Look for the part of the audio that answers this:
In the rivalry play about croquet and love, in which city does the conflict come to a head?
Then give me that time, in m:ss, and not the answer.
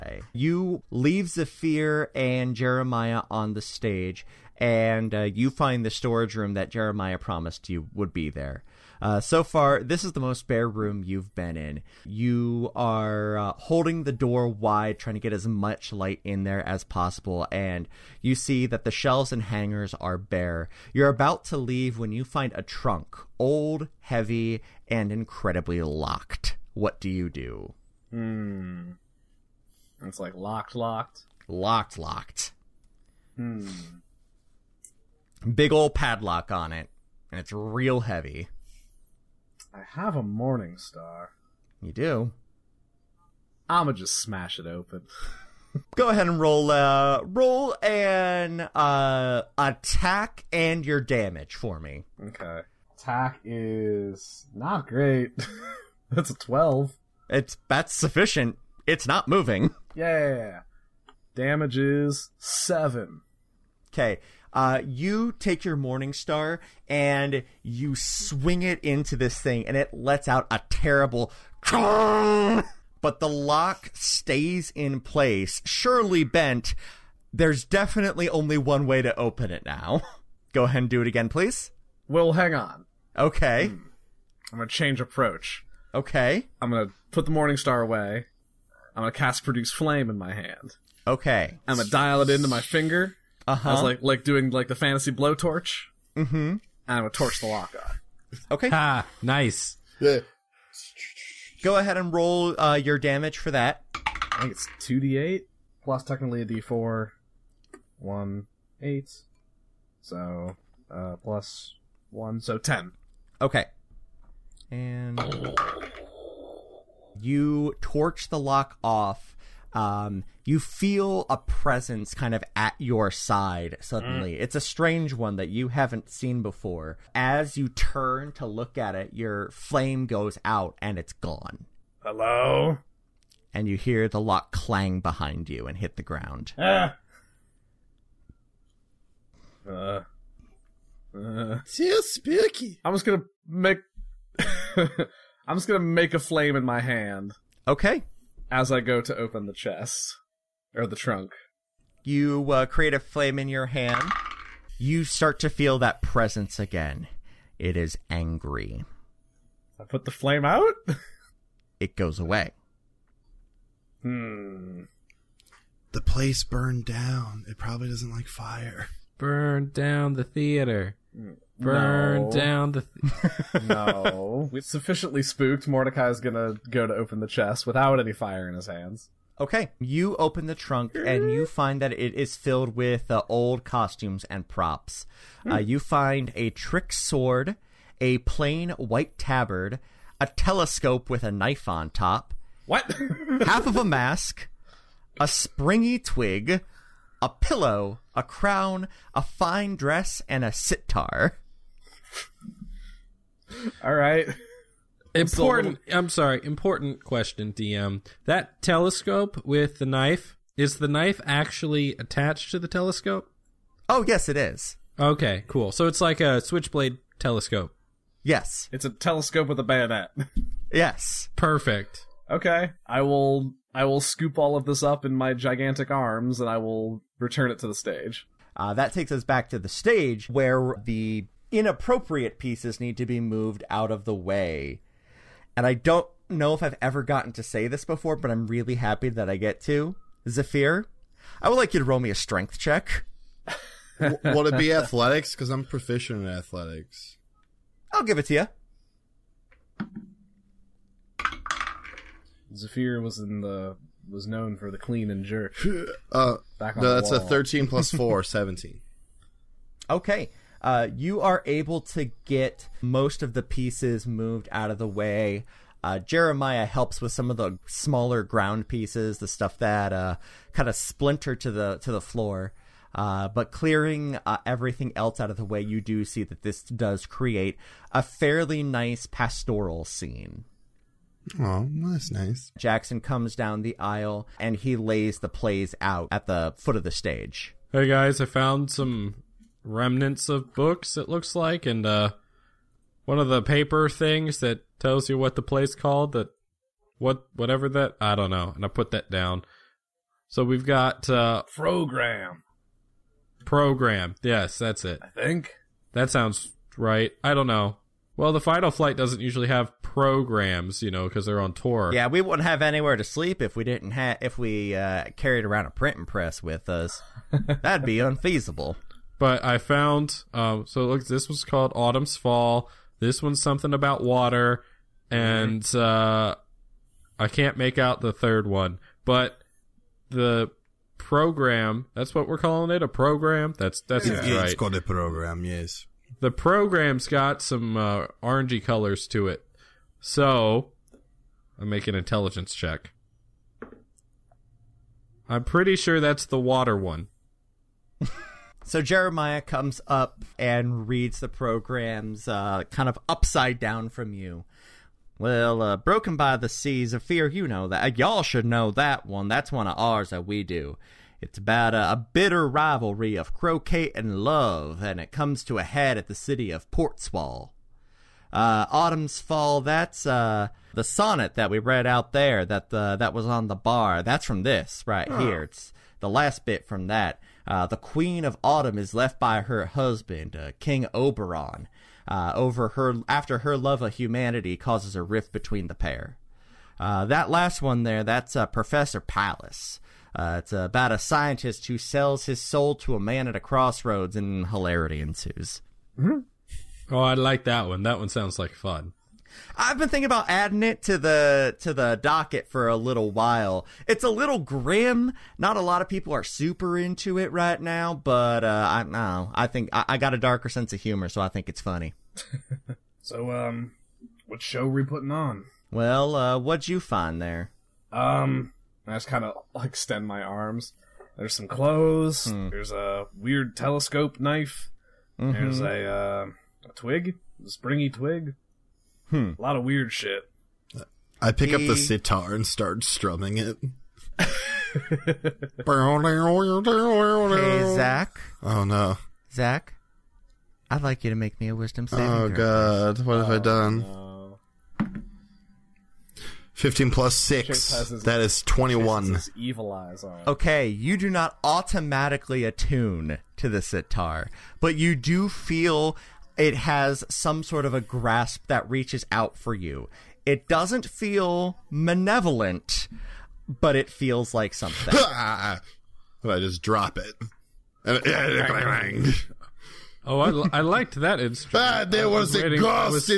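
6:06.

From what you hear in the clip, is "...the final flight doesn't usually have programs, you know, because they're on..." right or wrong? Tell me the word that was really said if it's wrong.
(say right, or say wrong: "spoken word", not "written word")
right.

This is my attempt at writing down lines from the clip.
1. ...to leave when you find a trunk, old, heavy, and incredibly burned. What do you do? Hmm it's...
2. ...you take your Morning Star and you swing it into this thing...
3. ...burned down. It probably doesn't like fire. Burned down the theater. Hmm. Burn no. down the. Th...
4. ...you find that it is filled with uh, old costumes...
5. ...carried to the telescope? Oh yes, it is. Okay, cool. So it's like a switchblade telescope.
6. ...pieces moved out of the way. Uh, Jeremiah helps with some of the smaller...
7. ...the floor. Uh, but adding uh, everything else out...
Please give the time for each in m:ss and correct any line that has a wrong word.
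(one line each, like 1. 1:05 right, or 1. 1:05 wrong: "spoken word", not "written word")
1. 0:21 wrong: "locked", not "burned"
2. 1:04 right
3. 2:46 right
4. 3:01 right
5. 3:31 wrong: "attached", not "carried"
6. 4:23 right
7. 4:31 wrong: "clearing", not "adding".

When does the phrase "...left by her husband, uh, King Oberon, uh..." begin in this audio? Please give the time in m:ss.
6:18.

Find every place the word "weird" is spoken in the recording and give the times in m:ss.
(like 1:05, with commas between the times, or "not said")
7:03, 7:09.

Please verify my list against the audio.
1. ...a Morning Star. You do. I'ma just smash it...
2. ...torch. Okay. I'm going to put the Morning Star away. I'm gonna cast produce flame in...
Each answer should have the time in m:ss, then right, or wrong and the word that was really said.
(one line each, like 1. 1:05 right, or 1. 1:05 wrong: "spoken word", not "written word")
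1. 0:40 right
2. 1:25 wrong: "approach", not "torch".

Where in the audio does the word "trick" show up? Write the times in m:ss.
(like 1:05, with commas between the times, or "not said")
3:06.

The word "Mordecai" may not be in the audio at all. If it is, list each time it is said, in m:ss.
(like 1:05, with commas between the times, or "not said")
2:55.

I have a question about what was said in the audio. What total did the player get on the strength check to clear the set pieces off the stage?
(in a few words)
17.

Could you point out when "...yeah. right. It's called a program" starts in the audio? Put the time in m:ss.
5:34.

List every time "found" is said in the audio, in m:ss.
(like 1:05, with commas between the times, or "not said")
4:48, 5:19.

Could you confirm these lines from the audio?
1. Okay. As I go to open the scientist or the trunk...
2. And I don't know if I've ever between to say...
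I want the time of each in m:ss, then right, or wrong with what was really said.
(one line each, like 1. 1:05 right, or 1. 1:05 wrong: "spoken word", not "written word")
1. 2:27 wrong: "chest", not "scientist"
2. 3:55 wrong: "gotten", not "between".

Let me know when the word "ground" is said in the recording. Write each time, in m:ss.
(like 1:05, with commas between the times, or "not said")
2:16, 4:28.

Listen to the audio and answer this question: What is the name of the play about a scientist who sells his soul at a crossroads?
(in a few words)
Professor Pallas.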